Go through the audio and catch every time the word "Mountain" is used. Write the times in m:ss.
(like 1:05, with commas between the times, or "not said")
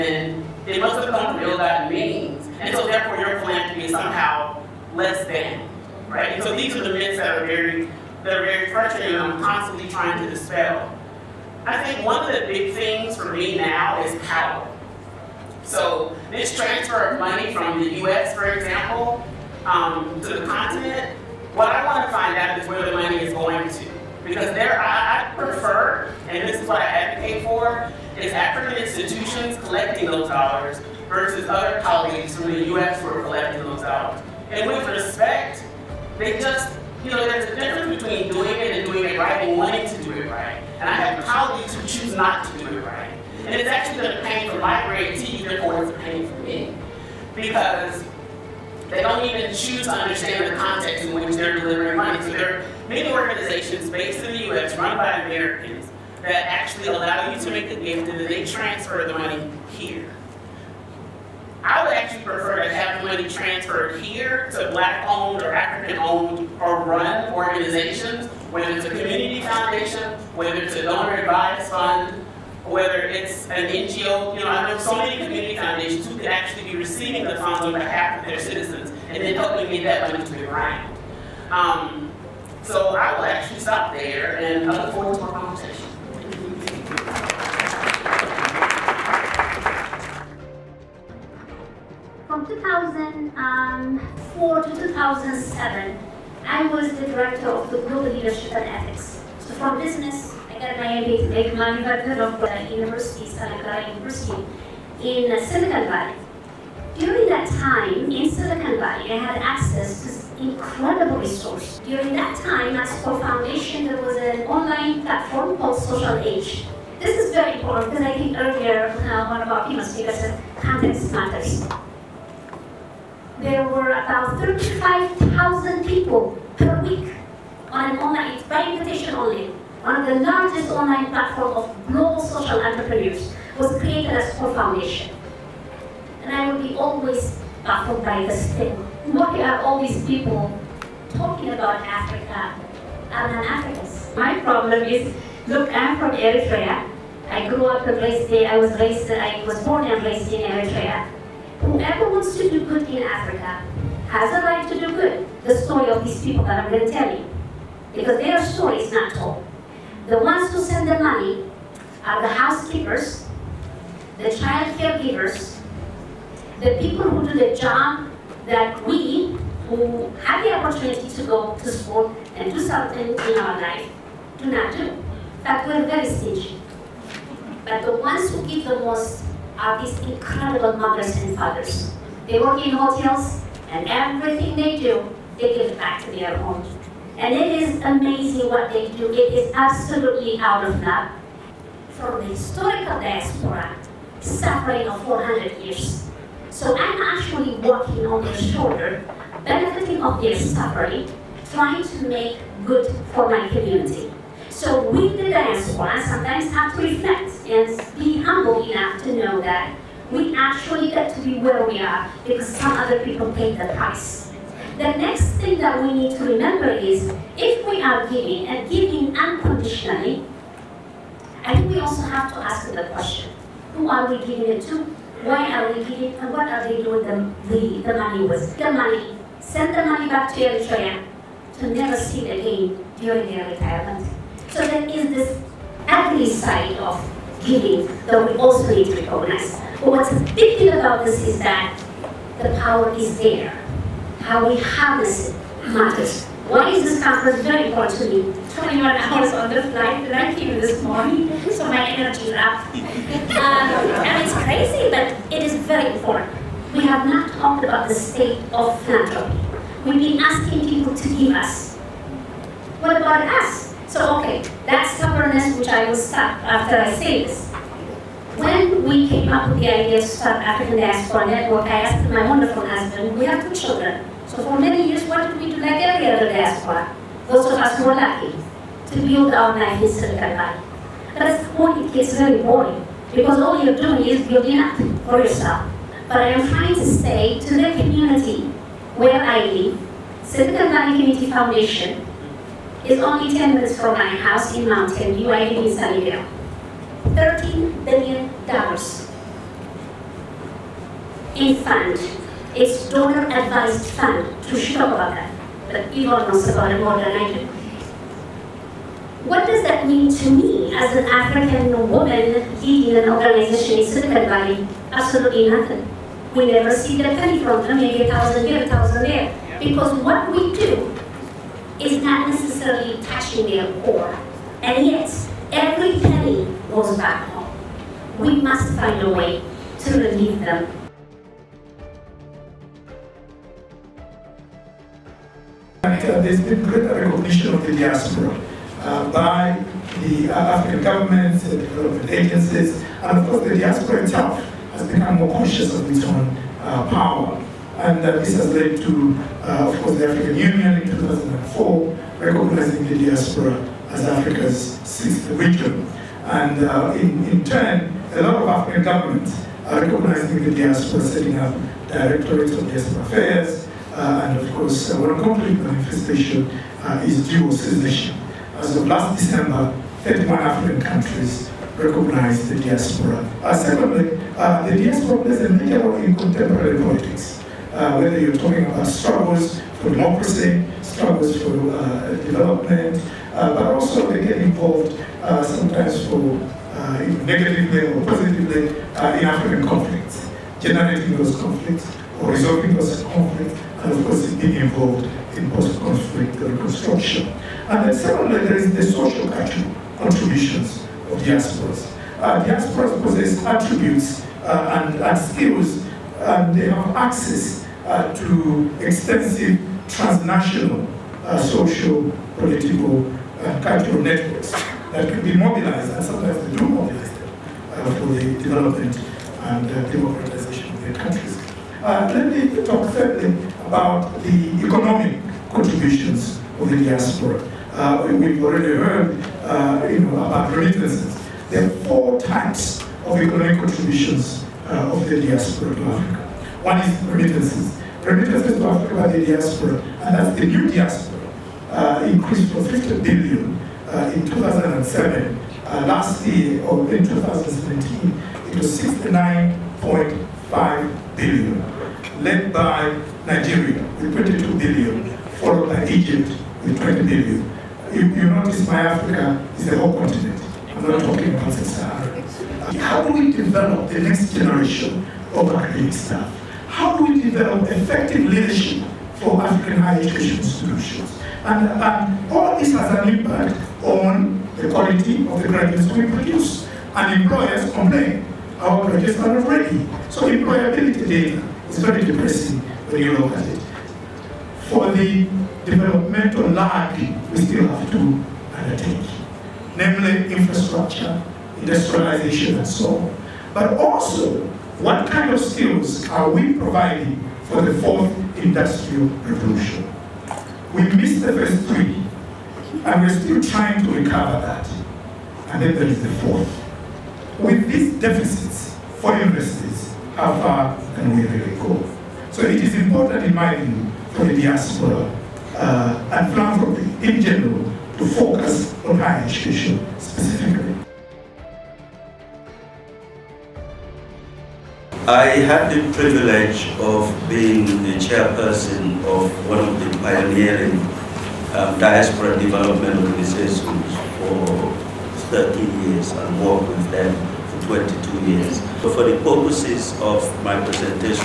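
4:54.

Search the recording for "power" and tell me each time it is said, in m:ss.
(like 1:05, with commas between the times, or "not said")
0:14, 4:02, 5:46.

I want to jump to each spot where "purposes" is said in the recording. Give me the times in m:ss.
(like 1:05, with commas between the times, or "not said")
8:59.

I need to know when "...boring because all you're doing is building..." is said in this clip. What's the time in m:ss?
4:42.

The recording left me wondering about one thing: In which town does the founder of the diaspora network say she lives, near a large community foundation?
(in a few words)
Sunnyvale.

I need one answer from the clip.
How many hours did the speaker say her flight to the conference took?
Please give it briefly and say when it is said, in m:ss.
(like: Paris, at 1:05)
21, at 4:08.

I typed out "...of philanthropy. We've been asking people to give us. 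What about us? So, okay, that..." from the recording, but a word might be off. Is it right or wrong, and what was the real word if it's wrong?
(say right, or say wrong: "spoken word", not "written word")
right.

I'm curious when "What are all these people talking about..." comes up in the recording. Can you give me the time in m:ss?
2:19.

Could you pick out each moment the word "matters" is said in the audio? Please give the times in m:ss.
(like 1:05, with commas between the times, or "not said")
2:01, 4:05.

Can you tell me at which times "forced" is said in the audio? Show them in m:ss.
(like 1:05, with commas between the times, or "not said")
not said.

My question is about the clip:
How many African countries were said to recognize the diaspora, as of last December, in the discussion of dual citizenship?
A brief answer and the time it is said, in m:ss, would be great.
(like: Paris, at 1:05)
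31, at 6:10.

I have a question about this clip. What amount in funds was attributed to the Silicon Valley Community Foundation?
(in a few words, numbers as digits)
$13 billion.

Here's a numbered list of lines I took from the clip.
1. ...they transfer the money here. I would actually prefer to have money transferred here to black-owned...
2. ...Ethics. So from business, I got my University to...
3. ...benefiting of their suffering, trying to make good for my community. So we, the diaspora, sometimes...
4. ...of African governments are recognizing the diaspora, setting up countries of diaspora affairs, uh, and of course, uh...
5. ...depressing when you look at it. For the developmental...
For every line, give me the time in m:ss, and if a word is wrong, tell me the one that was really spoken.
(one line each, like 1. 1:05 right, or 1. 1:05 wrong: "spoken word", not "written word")
1. 0:58 right
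2. 1:38 wrong: "MBA", not "University"
3. 3:19 right
4. 5:58 wrong: "directorates", not "countries"
5. 8:02 right.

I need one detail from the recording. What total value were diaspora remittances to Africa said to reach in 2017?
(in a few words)
69.5 billion.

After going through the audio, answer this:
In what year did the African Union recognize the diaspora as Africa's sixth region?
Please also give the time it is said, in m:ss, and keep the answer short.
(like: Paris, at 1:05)
2004, at 5:50.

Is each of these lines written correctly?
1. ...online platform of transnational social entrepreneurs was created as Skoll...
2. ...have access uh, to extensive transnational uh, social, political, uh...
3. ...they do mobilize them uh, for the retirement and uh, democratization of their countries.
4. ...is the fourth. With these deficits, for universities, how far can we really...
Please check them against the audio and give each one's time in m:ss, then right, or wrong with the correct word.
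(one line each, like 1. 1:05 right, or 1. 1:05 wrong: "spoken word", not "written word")
1. 2:10 wrong: "global", not "transnational"
2. 6:46 right
3. 6:56 wrong: "development", not "retirement"
4. 8:25 right.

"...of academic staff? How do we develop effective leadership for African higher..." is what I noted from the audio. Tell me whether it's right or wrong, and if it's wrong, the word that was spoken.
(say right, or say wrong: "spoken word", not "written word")
right.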